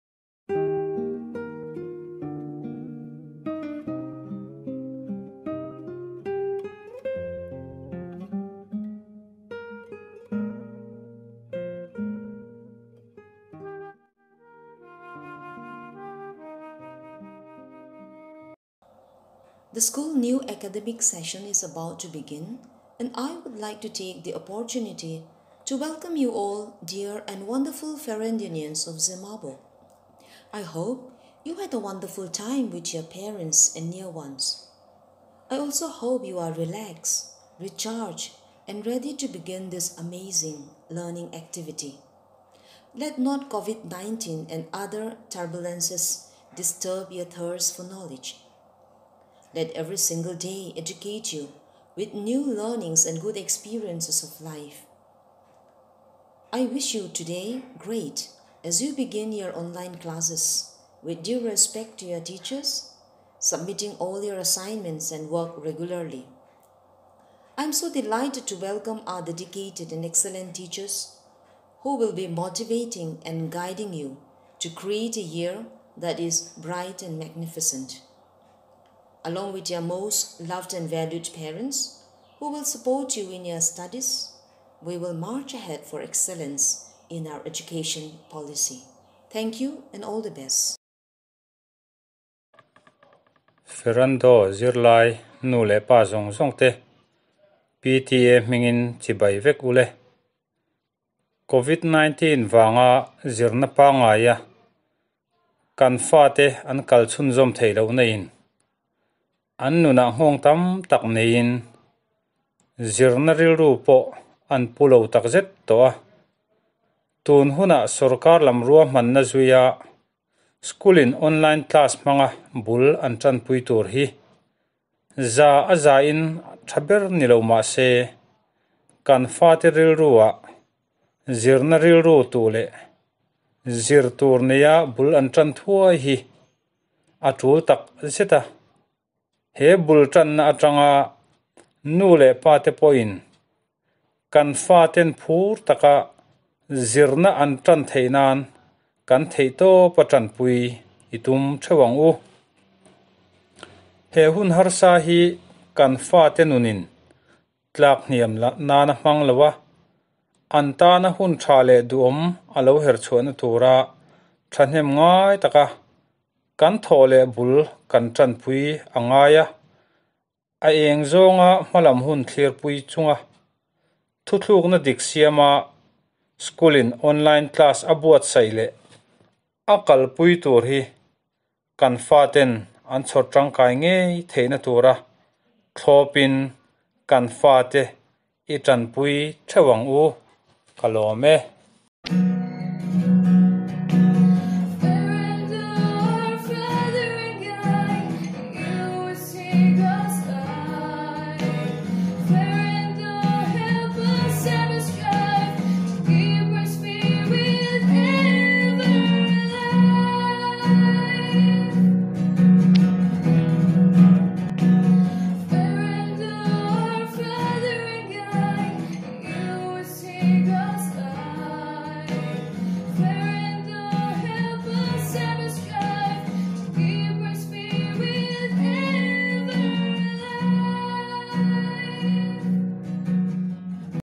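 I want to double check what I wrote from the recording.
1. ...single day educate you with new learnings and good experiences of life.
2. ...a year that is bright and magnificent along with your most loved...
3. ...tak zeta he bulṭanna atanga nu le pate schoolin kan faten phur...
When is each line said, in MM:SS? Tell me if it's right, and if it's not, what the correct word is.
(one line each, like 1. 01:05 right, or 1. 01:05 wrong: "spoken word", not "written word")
1. 00:49 right
2. 01:15 right
3. 02:17 wrong: "pawin", not "schoolin".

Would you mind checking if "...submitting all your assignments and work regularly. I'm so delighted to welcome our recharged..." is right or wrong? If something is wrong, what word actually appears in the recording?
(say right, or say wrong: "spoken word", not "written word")
wrong: "dedicated", not "recharged".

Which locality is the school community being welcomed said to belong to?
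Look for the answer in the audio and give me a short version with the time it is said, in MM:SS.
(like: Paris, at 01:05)
Zemabawk, at 00:28.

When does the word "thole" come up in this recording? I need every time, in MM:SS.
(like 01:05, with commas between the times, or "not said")
02:46.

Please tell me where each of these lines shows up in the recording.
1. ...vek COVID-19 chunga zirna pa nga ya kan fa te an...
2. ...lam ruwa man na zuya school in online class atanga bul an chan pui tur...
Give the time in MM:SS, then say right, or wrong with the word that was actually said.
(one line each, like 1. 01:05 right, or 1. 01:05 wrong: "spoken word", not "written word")
1. 01:39 wrong: "vanga", not "chunga"
2. 01:58 wrong: "manga", not "atanga".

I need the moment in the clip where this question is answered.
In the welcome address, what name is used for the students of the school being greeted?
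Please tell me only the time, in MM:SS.
00:27.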